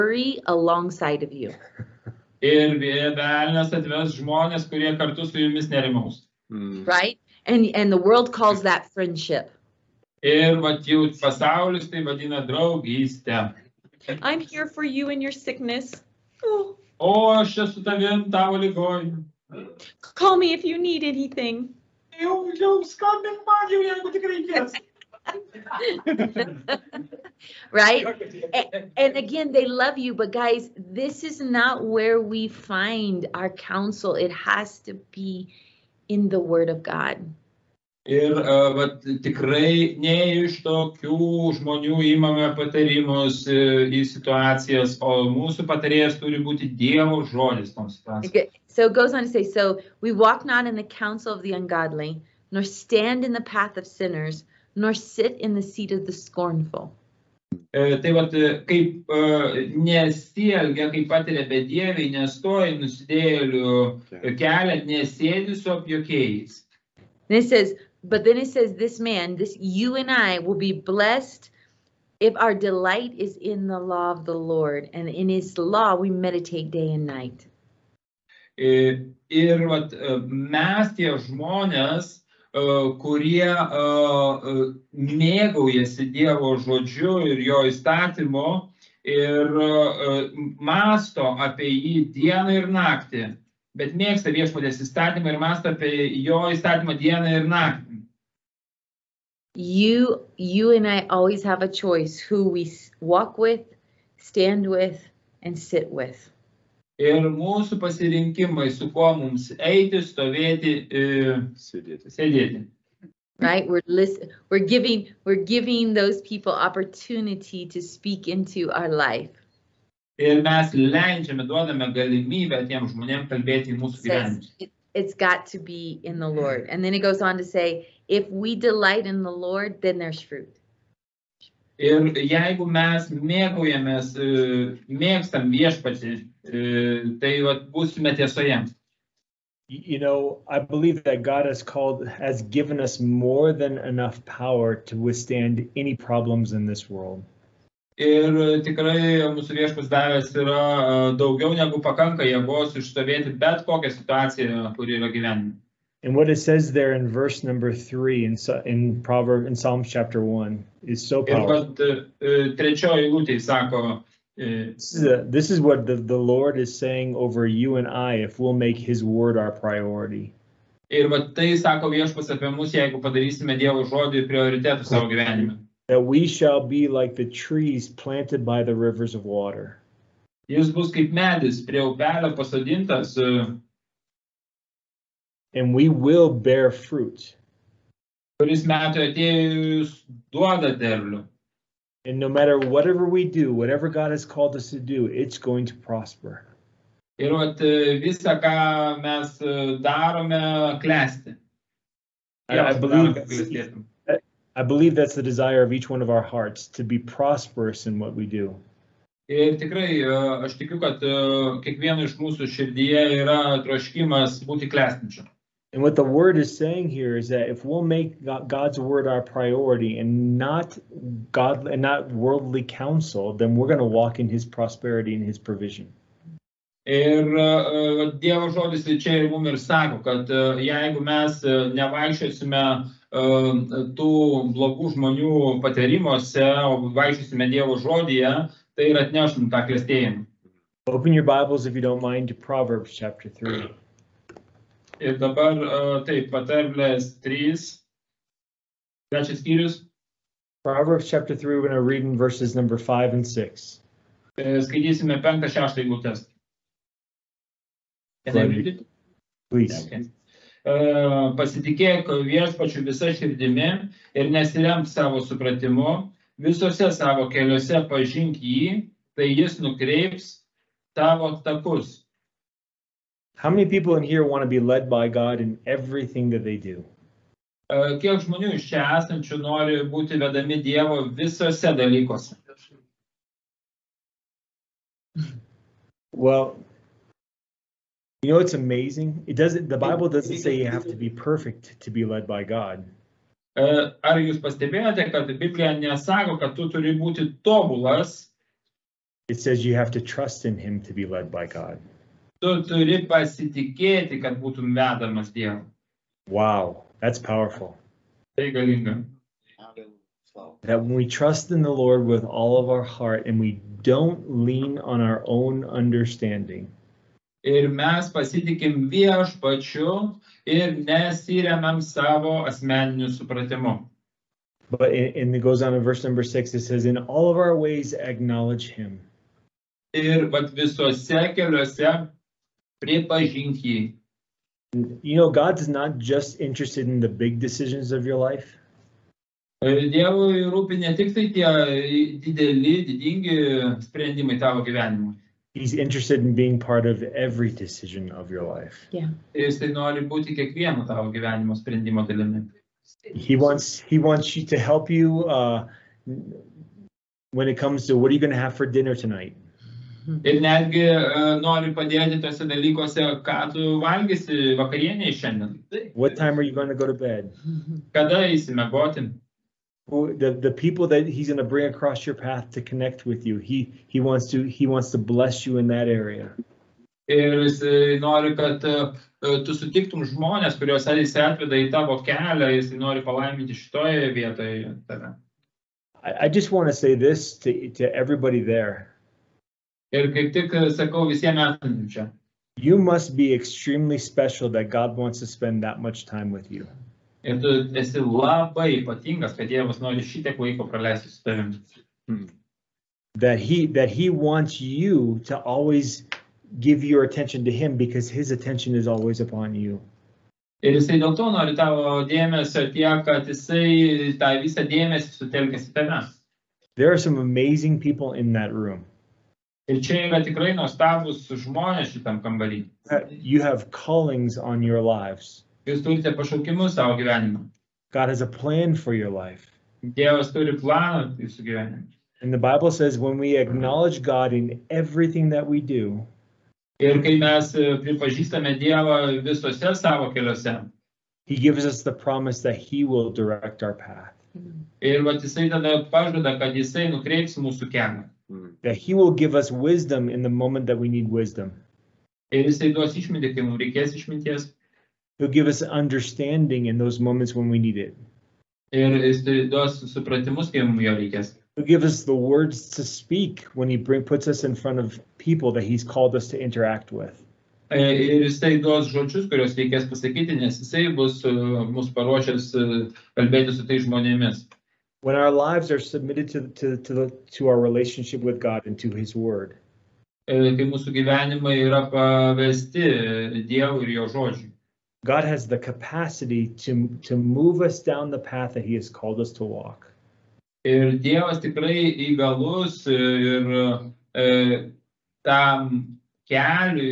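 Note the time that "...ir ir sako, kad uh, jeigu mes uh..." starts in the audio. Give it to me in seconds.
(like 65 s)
229 s.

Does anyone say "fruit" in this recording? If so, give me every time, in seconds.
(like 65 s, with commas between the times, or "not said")
130 s, 186 s.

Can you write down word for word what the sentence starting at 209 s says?
Ir tikrai aš tikiu, kad kiekvieno iš mūsų širdyje yra troškimas būti klestinčiu.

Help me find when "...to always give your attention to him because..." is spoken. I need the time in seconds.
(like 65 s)
405 s.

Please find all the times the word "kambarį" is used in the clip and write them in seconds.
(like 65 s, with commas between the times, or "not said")
422 s.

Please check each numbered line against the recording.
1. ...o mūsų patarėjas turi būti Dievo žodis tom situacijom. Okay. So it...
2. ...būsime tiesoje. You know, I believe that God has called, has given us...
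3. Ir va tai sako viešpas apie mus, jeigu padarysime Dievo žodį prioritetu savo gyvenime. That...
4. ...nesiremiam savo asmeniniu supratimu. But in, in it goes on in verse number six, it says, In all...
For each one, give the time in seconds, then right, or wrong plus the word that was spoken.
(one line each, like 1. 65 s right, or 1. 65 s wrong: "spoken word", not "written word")
1. 44 s right
2. 137 s right
3. 170 s right
4. 320 s right.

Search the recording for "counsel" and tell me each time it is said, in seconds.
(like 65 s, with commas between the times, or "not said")
33 s, 50 s, 222 s.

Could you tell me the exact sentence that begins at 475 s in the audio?
when our lives are submitted to to to, the, to our relationship with God and to His Word.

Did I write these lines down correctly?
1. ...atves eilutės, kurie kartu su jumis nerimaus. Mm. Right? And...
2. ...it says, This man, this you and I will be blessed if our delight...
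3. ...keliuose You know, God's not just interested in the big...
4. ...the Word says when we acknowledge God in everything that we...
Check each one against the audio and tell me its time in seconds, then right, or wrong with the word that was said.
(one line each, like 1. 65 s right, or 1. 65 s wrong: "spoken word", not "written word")
1. 3 s wrong: "žmonės", not "eilutės"
2. 68 s right
3. 331 s right
4. 432 s wrong: "Bible", not "Word".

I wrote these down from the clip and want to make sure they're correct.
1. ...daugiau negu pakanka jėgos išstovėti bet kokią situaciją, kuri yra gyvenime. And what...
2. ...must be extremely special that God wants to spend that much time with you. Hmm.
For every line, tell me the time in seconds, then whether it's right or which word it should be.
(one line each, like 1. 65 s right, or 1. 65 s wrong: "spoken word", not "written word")
1. 151 s right
2. 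392 s right.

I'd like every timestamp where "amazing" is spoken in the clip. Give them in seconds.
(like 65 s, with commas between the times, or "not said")
288 s, 417 s.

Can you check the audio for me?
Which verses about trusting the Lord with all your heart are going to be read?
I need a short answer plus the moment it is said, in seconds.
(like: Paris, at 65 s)
5 and 6, at 252 s.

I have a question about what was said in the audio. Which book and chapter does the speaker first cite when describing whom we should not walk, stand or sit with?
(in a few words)
Psalms chapter 1.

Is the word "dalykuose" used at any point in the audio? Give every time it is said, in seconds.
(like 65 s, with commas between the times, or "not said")
281 s, 362 s.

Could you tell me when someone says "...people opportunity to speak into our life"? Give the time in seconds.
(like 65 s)
116 s.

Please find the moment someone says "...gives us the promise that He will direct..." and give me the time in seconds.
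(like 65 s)
441 s.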